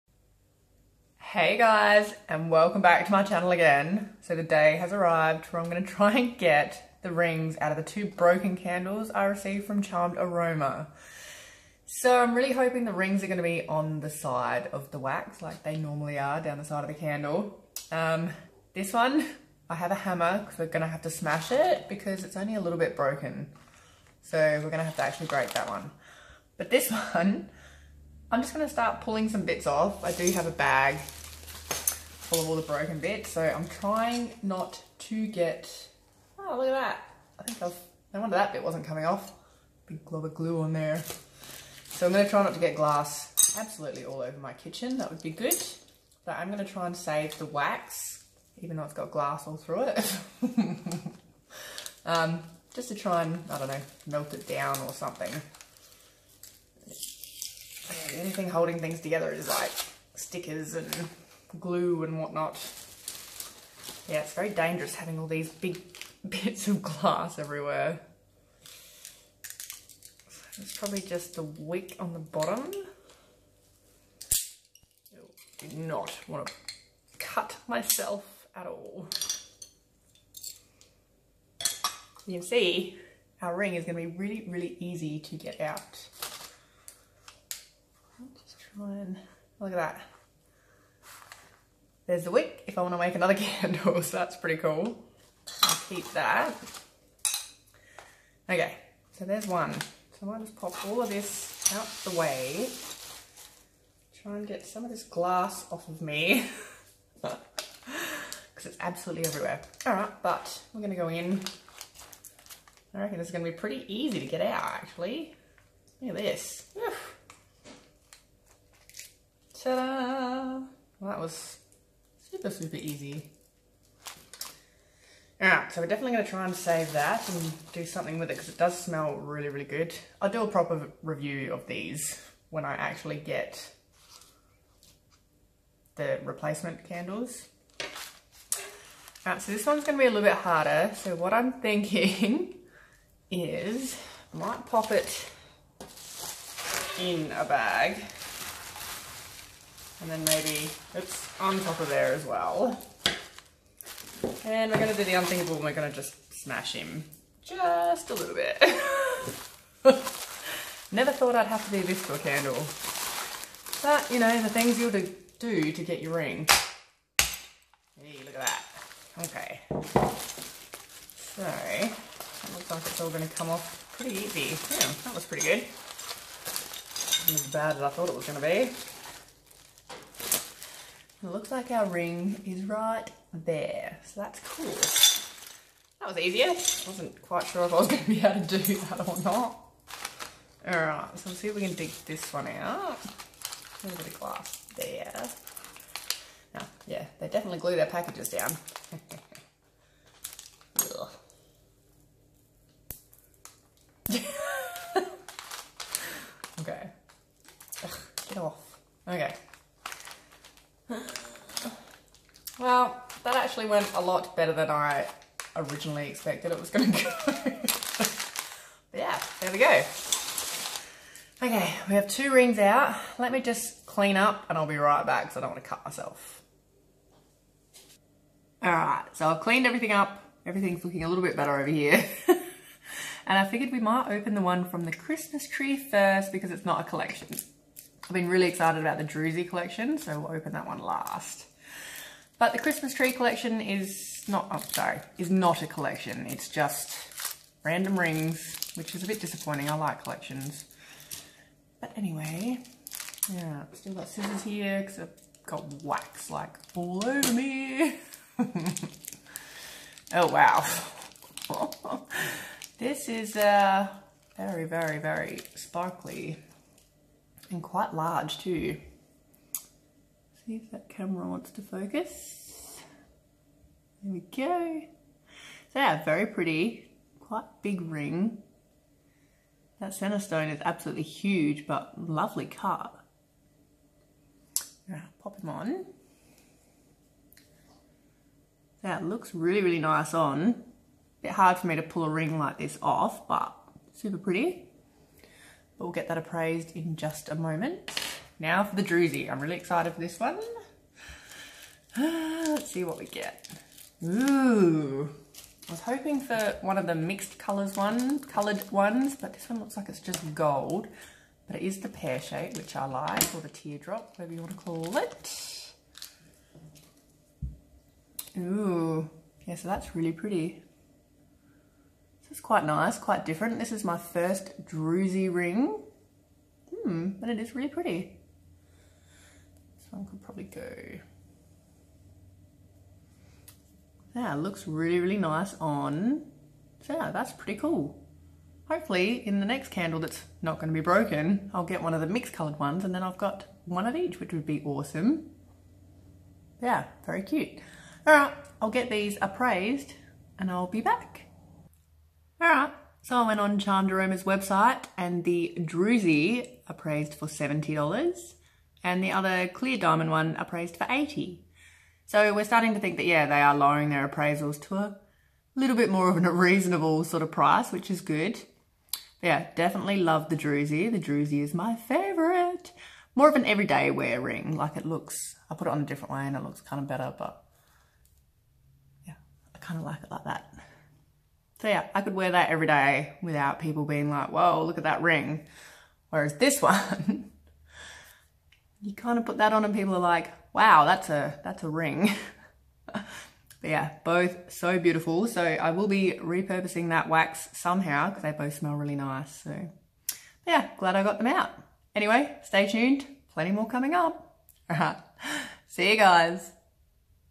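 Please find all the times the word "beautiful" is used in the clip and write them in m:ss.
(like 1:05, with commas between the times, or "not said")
6:34.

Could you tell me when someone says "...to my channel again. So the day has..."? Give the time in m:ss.
0:03.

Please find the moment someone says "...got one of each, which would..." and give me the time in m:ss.
5:43.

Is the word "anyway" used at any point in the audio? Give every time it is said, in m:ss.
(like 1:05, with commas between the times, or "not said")
4:11, 6:41.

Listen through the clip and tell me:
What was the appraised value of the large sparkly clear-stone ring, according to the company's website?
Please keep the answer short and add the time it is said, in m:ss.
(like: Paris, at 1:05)
$80, at 6:00.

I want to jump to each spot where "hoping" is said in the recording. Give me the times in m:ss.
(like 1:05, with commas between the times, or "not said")
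0:12, 5:05.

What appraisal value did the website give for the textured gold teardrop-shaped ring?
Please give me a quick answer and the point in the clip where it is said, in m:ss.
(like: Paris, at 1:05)
$70, at 5:57.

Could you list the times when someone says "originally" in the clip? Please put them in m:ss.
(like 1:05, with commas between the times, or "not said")
3:35.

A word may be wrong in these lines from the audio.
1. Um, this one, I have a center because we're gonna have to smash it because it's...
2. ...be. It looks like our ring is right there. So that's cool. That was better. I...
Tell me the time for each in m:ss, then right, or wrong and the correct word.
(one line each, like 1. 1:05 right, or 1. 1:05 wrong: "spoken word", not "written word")
1. 0:17 wrong: "hammer", not "center"
2. 2:58 wrong: "easier", not "better".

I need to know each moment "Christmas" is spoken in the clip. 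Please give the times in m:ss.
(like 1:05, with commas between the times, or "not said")
3:54, 4:02.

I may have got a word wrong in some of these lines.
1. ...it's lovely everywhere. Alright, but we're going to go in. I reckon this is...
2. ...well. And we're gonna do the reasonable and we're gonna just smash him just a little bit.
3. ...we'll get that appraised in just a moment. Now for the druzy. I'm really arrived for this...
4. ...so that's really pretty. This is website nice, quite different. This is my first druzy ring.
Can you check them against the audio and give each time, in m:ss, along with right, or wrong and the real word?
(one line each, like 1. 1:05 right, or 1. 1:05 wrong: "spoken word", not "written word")
1. 1:48 wrong: "absolutely", not "lovely"
2. 2:32 wrong: "unthinkable", not "reasonable"
3. 4:55 wrong: "excited", not "arrived"
4. 5:19 wrong: "quite", not "website".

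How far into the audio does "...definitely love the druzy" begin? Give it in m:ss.
6:09.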